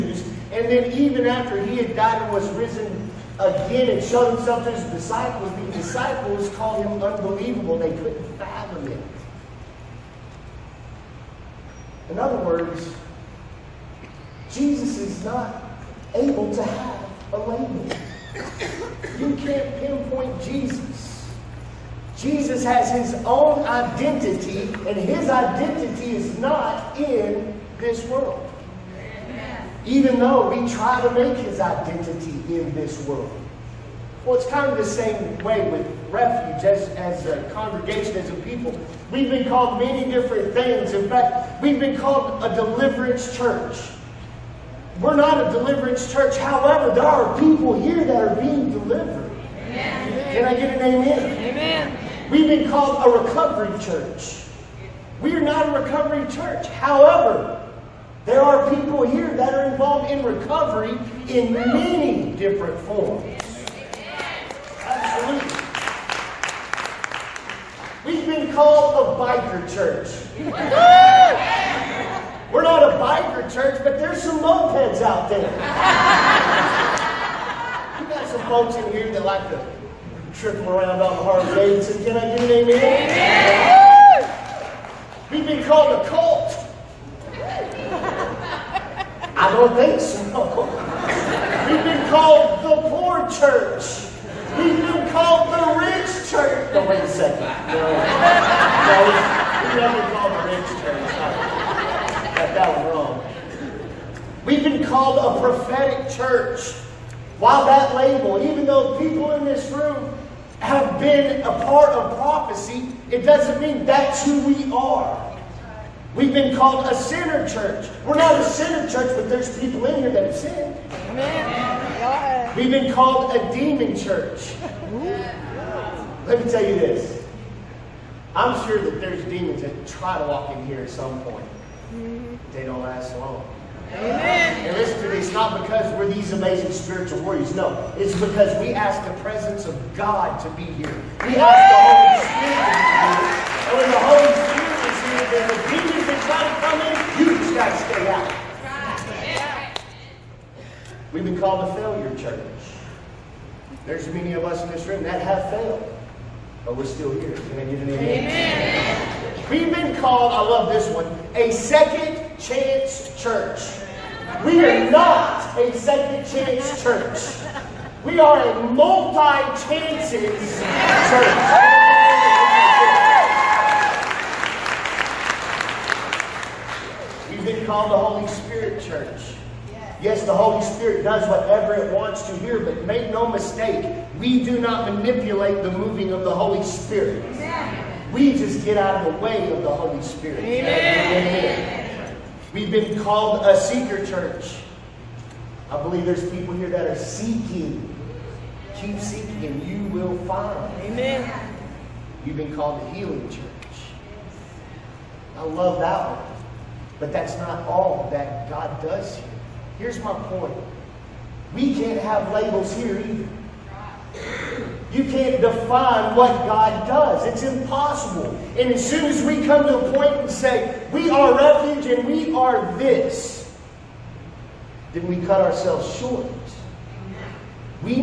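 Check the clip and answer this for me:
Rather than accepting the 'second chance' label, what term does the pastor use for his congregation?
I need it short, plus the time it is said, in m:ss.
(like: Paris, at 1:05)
multi chances church, at 2:48.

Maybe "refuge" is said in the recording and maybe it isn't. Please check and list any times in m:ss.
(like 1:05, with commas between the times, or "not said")
0:36, 3:41.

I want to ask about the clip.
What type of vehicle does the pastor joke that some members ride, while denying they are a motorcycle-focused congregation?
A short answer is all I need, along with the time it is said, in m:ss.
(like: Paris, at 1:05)
mopeds, at 1:14.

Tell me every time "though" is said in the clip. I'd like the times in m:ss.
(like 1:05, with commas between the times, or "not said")
0:30, 1:48.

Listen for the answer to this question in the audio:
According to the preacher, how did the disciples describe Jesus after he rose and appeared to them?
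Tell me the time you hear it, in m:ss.
0:07.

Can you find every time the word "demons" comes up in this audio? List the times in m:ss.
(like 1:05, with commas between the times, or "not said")
2:03, 2:09, 2:25.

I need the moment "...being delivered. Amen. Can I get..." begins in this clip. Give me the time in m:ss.
0:48.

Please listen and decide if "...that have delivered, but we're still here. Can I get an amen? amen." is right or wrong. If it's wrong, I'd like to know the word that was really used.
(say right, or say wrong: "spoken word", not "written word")
wrong: "failed", not "delivered".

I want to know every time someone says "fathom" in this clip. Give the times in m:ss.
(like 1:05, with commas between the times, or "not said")
0:08.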